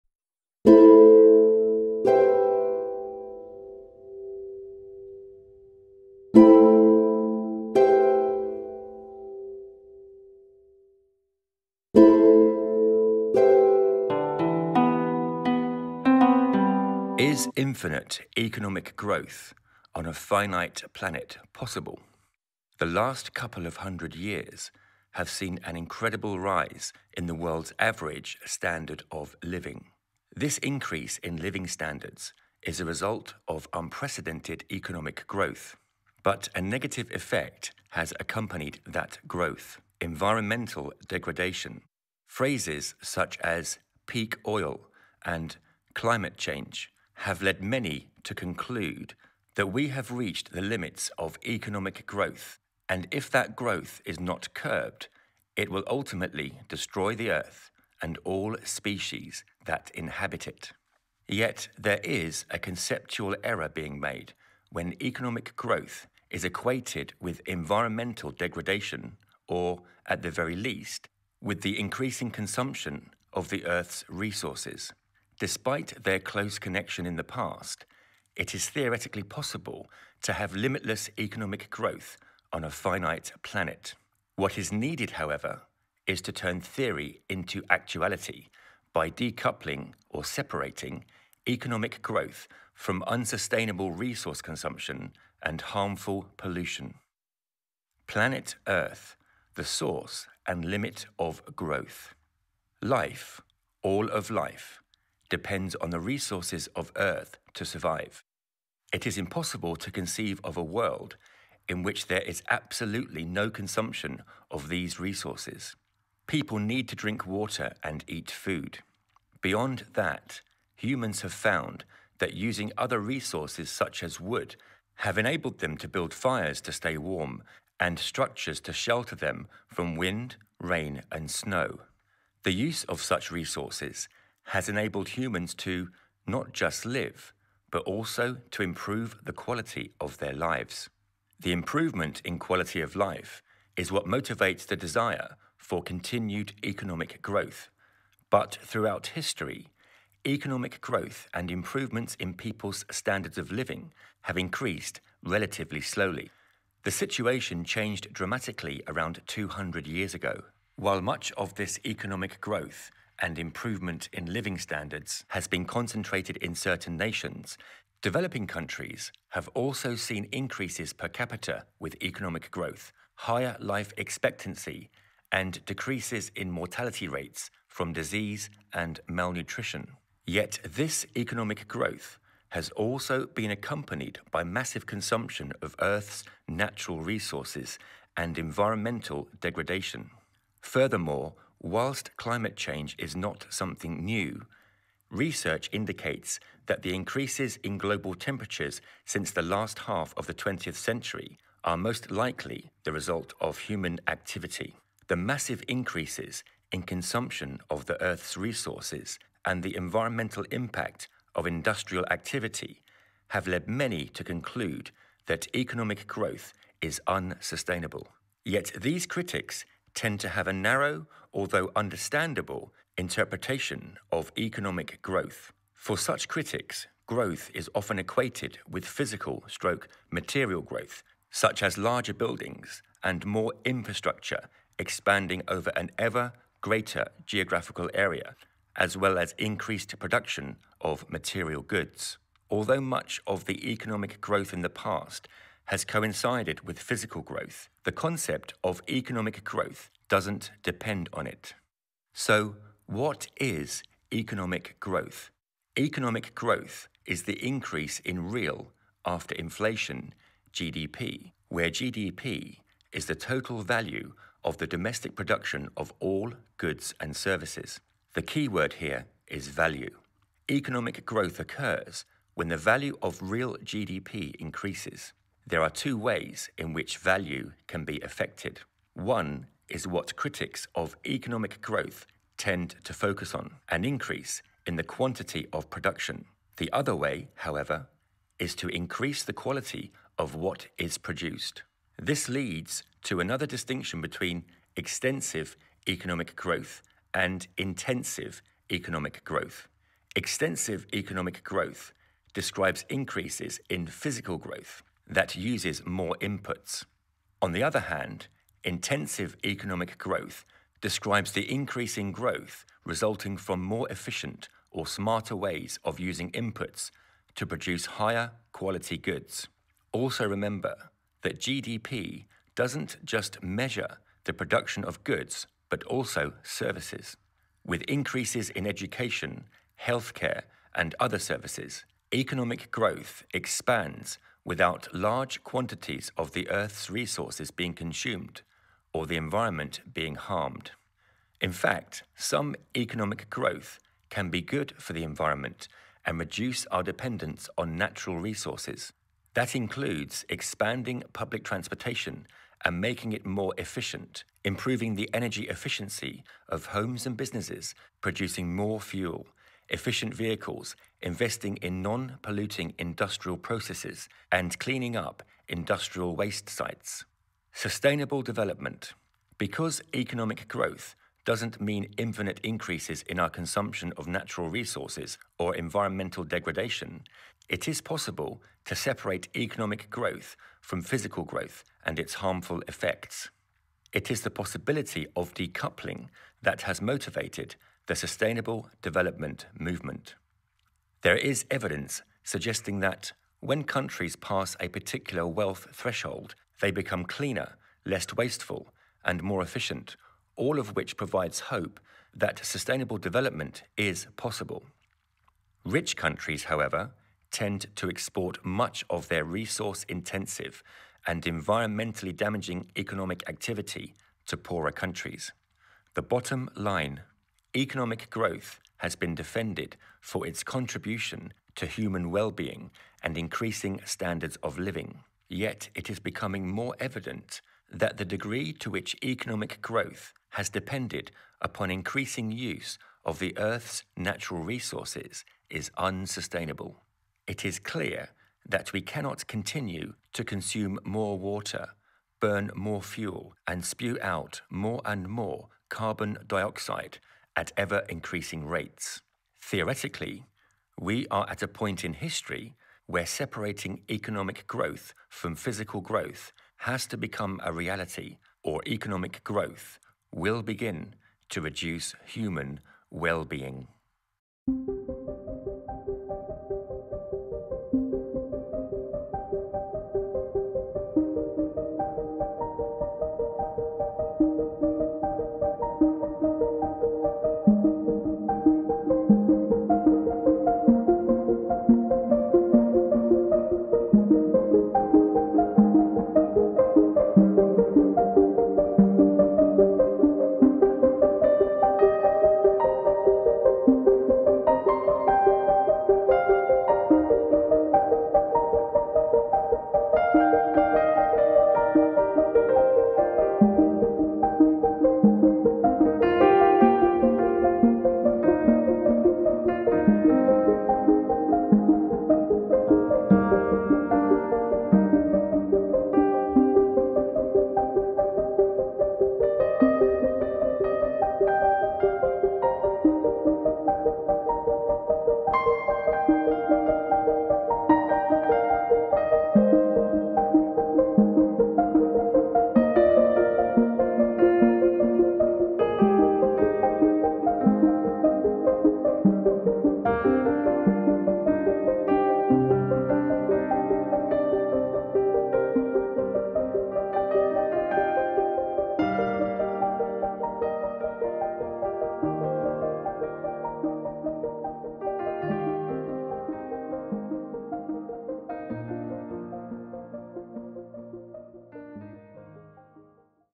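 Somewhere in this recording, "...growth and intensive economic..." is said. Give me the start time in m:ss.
4:56.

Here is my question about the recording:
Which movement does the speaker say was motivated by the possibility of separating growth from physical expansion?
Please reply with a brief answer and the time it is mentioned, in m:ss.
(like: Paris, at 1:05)
Sustainable Development Movement, at 6:27.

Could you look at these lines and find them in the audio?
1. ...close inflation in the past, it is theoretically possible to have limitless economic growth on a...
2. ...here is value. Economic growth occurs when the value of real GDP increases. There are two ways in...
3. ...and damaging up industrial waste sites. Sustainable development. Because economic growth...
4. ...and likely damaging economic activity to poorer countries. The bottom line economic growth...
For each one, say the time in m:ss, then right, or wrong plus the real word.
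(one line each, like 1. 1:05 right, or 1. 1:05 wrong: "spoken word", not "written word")
1. 1:16 wrong: "connection", not "inflation"
2. 4:28 right
3. 6:04 wrong: "cleaning", not "damaging"
4. 6:51 wrong: "environmentally", not "likely".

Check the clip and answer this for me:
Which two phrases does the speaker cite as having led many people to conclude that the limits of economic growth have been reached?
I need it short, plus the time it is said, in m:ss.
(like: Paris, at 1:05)
peak oil and climate change, at 0:44.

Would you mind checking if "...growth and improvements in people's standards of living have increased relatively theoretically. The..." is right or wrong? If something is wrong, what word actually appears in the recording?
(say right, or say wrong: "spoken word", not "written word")
wrong: "slowly", not "theoretically".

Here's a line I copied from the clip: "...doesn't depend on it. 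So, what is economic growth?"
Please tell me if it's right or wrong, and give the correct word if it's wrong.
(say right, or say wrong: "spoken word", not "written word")
right.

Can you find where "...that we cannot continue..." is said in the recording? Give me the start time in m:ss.
7:18.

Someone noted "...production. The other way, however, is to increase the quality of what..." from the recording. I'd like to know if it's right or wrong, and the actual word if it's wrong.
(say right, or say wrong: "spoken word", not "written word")
right.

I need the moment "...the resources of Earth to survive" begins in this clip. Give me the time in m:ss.
1:45.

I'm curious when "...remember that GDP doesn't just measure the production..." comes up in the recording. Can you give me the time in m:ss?
5:20.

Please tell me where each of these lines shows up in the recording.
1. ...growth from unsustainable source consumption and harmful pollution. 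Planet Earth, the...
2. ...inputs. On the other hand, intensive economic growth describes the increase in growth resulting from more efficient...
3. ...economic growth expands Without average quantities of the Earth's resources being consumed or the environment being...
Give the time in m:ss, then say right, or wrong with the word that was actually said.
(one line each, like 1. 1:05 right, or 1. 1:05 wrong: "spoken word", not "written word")
1. 1:32 wrong: "resource", not "source"
2. 5:06 right
3. 5:32 wrong: "large", not "average".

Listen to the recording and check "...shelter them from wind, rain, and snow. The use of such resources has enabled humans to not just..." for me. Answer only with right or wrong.
right.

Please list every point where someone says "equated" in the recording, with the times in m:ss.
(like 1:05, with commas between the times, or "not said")
1:06, 3:47.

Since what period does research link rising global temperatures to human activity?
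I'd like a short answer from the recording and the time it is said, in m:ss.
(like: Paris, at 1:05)
last half of the 20th century, at 3:19.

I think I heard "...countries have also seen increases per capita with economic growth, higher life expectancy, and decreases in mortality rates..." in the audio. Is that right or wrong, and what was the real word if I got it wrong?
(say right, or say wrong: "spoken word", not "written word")
right.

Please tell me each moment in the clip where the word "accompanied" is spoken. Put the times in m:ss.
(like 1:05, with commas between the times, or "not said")
0:38, 3:03.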